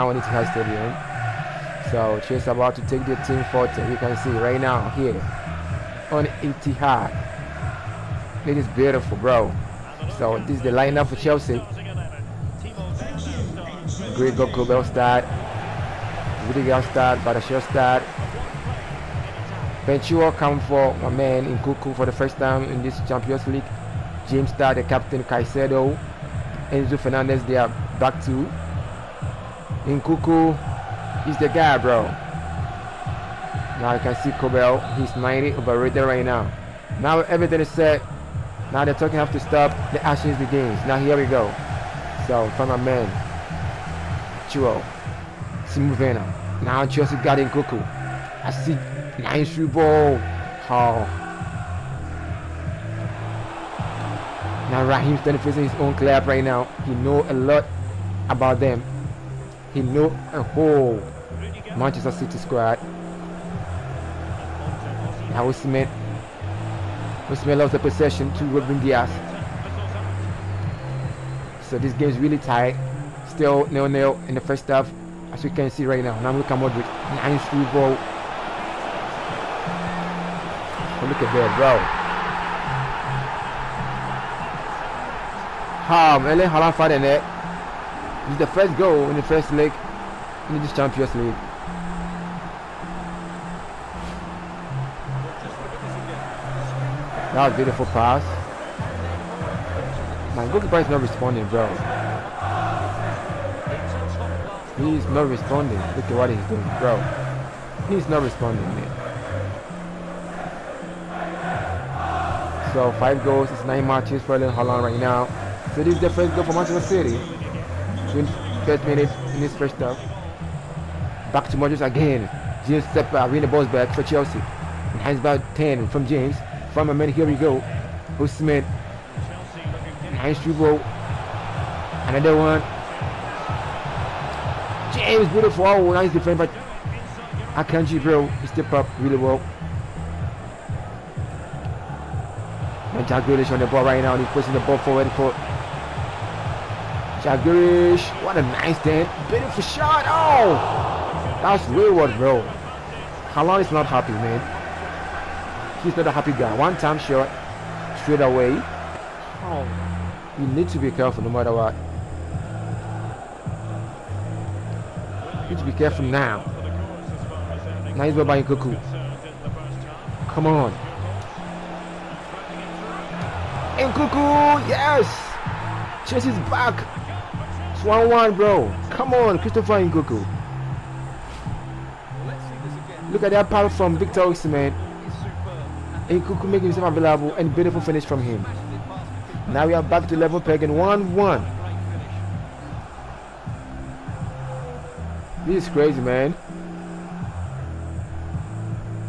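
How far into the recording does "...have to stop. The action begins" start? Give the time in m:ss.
0:39.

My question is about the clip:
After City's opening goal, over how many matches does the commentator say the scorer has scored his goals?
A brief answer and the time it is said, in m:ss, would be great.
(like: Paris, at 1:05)
9, at 1:53.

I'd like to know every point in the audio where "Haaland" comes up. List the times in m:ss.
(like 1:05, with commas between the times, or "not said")
1:26, 1:54.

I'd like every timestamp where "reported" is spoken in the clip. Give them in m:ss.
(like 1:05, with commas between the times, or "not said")
not said.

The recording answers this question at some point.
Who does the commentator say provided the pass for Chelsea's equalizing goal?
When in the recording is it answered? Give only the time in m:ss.
3:03.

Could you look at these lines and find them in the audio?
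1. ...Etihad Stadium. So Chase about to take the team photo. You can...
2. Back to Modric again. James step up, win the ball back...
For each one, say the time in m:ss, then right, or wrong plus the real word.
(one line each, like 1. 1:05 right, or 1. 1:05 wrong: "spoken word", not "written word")
1. 0:00 right
2. 2:01 right.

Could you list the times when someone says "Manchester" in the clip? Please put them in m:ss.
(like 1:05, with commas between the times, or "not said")
1:01, 1:56, 2:22.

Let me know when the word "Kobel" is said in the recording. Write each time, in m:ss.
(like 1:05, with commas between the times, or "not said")
0:14, 0:34.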